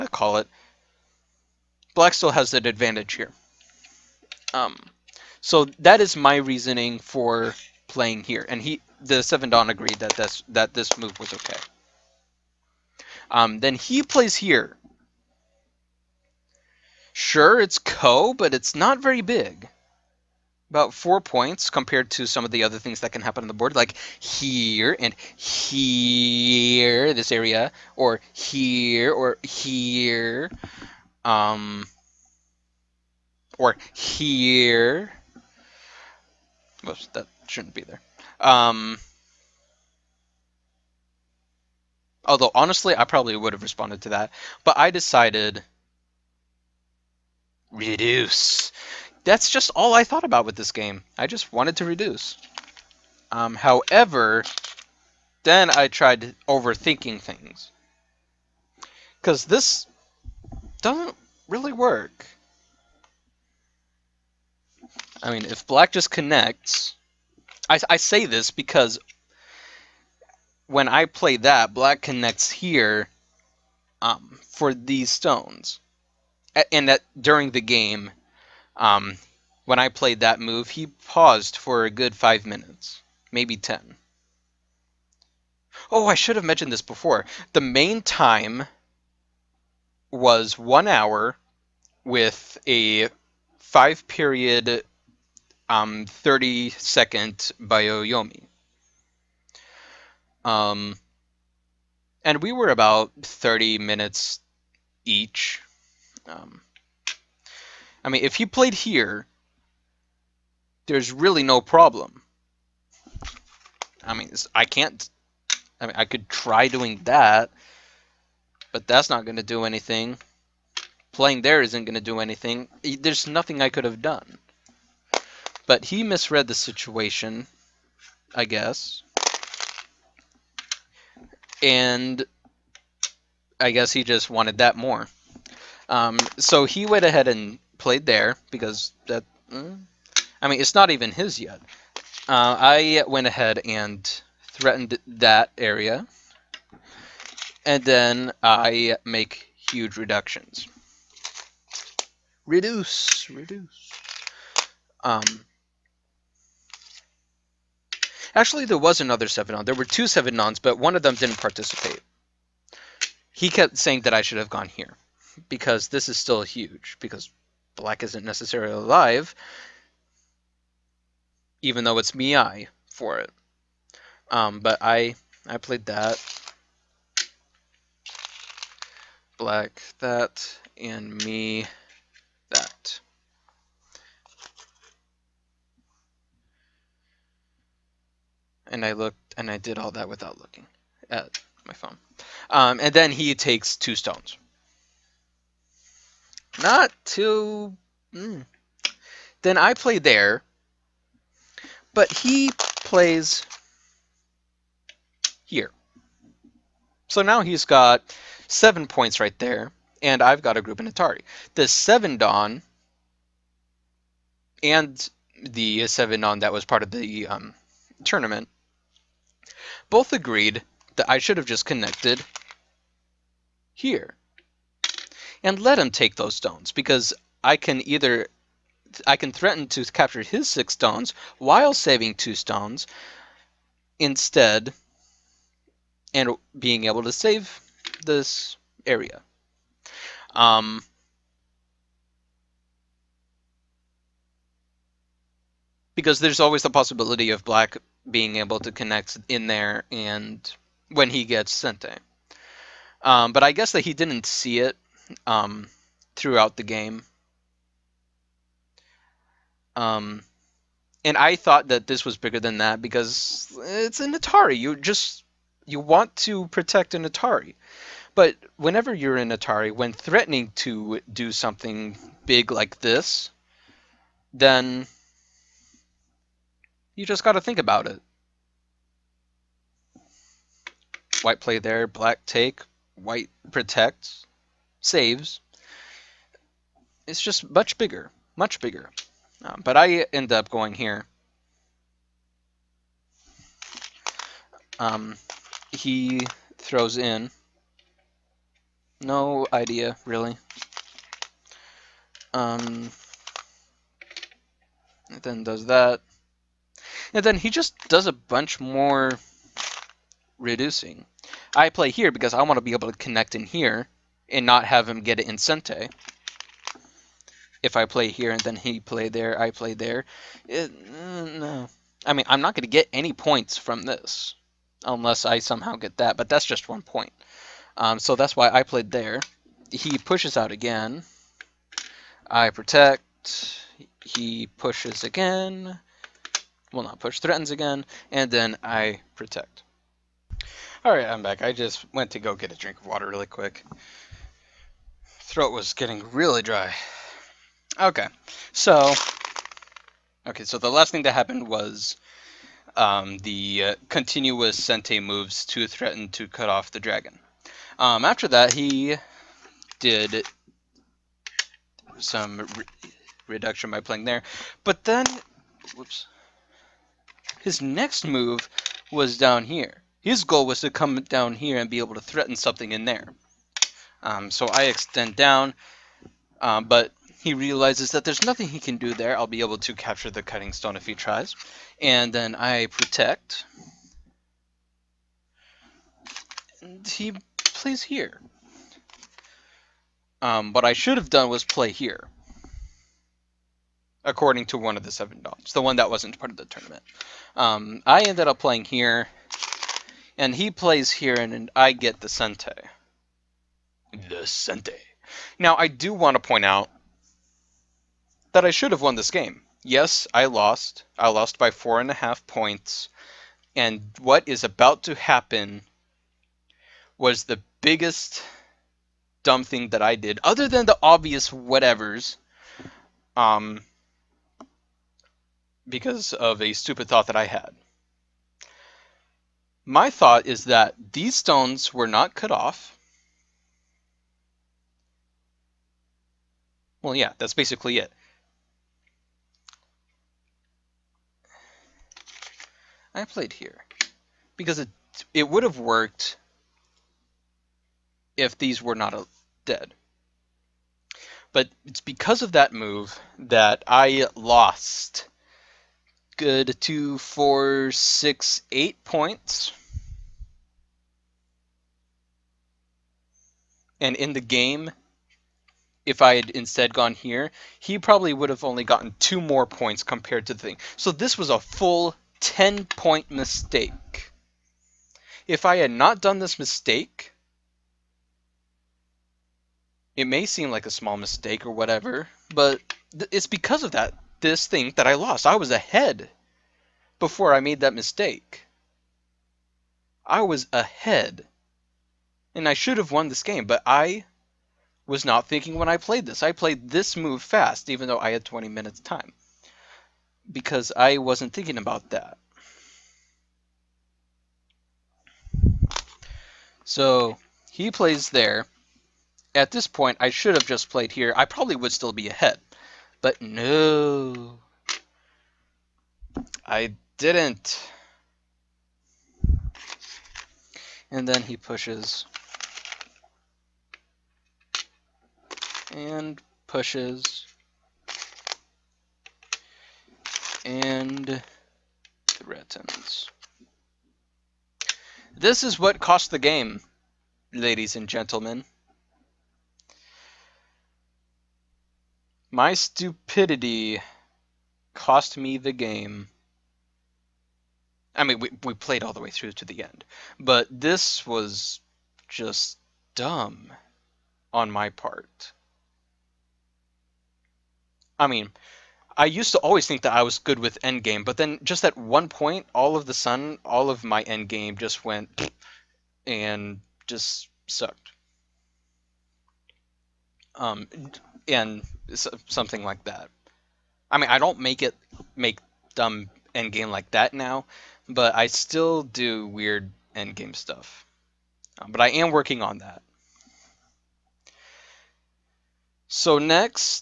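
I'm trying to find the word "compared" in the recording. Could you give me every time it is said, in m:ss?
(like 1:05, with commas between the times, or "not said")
0:21, 7:49.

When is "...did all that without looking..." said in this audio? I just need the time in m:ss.
3:09.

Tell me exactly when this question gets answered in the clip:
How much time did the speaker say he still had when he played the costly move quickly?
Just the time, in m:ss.
8:18.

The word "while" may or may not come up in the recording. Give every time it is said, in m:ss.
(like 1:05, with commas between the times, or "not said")
3:51.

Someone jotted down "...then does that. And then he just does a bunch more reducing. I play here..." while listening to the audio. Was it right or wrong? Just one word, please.
right.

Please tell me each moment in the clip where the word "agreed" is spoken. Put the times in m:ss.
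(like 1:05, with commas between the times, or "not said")
0:09, 3:40.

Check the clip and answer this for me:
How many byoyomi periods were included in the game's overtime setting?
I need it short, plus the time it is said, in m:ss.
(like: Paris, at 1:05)
5, at 1:33.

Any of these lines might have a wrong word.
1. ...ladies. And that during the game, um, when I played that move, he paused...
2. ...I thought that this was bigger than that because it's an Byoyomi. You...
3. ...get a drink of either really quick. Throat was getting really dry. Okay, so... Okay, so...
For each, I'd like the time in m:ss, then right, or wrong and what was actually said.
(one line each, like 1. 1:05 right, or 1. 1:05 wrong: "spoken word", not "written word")
1. 1:15 wrong: "stones", not "ladies"
2. 4:21 wrong: "Atari", not "Byoyomi"
3. 5:42 wrong: "water", not "either".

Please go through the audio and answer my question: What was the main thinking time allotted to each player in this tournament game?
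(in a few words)
1 hour.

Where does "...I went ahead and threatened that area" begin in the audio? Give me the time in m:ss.
2:22.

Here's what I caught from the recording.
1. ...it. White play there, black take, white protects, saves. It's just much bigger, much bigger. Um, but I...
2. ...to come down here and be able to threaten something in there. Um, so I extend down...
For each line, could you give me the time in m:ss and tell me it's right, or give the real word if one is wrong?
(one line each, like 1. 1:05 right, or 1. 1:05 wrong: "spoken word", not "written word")
1. 4:37 right
2. 6:10 right.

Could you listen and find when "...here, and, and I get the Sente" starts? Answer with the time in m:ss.
6:40.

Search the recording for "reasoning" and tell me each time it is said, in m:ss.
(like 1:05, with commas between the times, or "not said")
0:06.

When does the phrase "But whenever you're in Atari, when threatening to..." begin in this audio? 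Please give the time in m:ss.
4:28.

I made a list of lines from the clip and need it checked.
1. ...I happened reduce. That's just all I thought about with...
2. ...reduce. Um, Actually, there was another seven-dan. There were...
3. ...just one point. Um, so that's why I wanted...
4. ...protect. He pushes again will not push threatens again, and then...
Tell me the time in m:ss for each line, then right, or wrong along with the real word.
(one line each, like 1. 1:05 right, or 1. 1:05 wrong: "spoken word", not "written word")
1. 0:44 wrong: "decided", not "happened"
2. 2:33 right
3. 5:26 wrong: "played", not "wanted"
4. 5:32 right.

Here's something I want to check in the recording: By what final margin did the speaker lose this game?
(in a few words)
4.5 points.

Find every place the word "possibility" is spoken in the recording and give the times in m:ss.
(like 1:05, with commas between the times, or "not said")
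4:06.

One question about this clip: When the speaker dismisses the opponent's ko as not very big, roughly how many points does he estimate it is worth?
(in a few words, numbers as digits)
4 points.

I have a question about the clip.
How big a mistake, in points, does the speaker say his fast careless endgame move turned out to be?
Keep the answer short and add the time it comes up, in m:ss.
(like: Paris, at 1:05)
10 points, at 7:52.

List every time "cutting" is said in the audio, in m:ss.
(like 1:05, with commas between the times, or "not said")
6:20.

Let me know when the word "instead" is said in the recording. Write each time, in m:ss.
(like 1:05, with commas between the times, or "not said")
3:53, 7:46.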